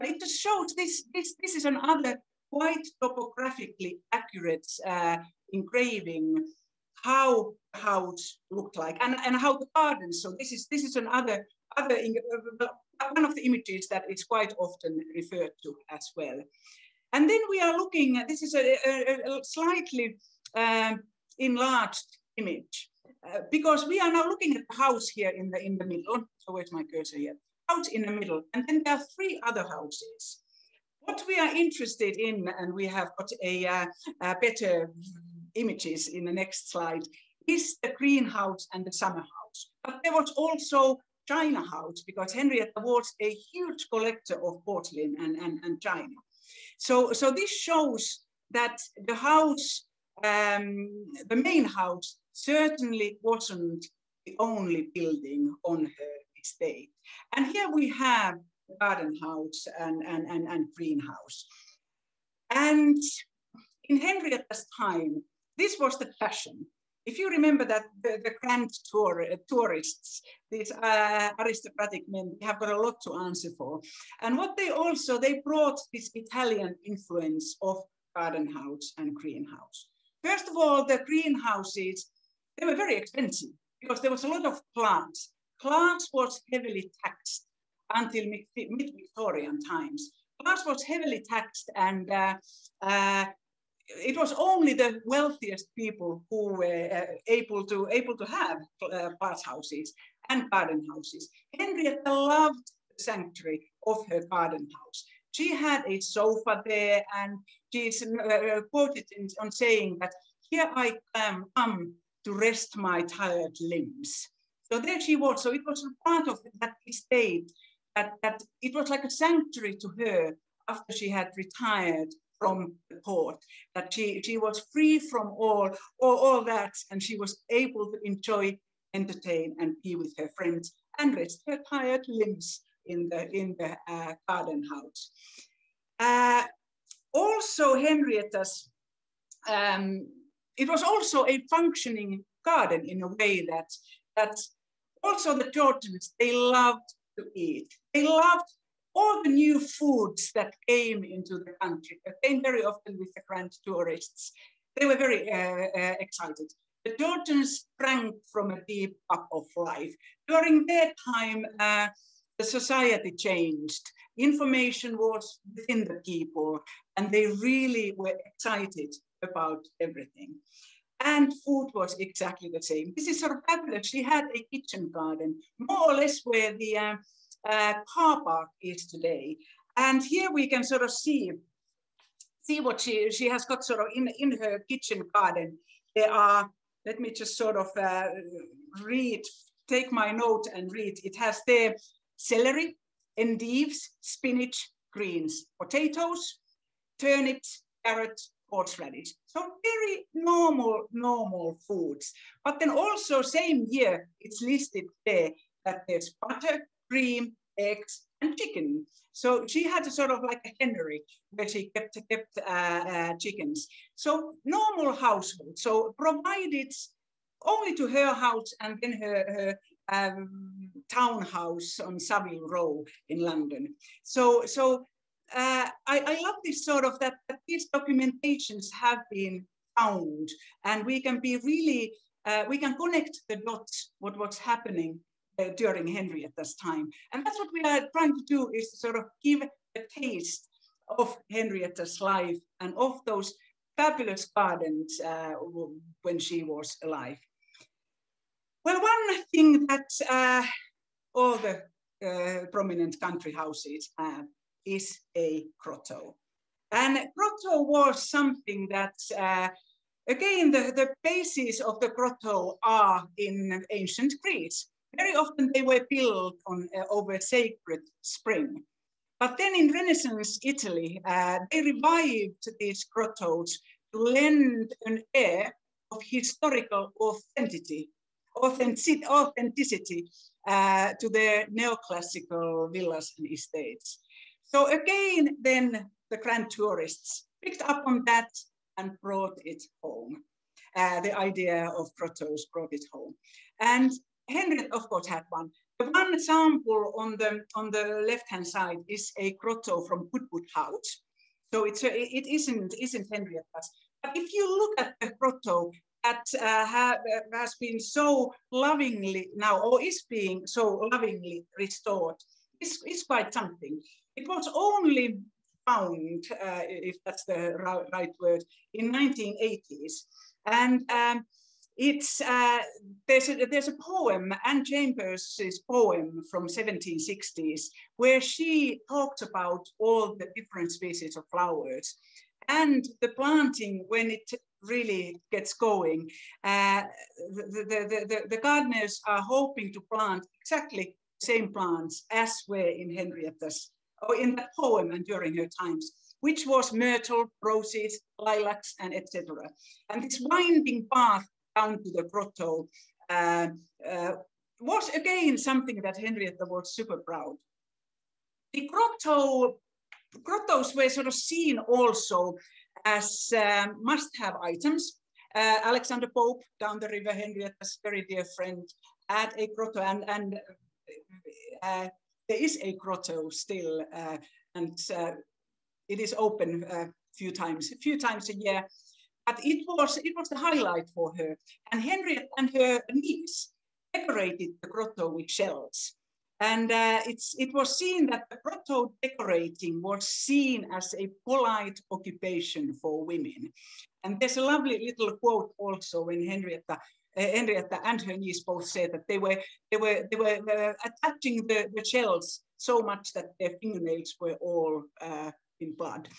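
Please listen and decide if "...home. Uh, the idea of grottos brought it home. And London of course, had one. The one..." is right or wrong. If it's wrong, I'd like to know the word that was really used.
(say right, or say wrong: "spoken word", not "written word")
wrong: "Henry", not "London".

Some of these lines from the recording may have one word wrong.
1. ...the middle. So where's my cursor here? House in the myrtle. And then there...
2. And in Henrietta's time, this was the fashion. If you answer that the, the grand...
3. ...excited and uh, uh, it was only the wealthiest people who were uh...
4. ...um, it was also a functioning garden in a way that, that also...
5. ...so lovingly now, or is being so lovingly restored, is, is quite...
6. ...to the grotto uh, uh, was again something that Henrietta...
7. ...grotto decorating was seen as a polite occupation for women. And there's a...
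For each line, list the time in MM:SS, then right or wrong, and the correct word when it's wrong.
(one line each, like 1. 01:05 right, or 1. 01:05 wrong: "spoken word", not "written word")
1. 00:25 wrong: "middle", not "myrtle"
2. 01:02 wrong: "remember", not "answer"
3. 01:31 wrong: "taxed", not "excited"
4. 02:19 right
5. 05:07 right
6. 05:51 right
7. 06:28 right.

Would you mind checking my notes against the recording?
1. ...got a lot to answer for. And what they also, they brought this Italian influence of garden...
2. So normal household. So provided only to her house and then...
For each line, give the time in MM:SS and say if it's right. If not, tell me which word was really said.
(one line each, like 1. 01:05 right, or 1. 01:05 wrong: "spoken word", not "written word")
1. 01:12 right
2. 03:33 right.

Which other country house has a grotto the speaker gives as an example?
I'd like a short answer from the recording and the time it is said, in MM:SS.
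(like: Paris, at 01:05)
Goodwood House, at 05:00.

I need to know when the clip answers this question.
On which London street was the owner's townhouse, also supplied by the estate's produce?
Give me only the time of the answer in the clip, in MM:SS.
03:41.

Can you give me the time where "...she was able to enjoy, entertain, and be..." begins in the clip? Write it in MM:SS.
02:07.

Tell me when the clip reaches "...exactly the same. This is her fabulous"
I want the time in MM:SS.
02:51.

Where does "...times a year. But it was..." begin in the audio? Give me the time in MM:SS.
06:17.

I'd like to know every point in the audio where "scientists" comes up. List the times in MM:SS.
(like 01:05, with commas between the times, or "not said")
not said.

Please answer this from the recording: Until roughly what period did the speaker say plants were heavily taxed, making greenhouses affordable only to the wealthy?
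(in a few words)
mid-Victorian times.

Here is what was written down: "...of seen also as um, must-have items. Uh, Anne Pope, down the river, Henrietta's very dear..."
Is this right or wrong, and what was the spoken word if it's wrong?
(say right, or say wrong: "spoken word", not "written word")
wrong: "Alexander", not "Anne".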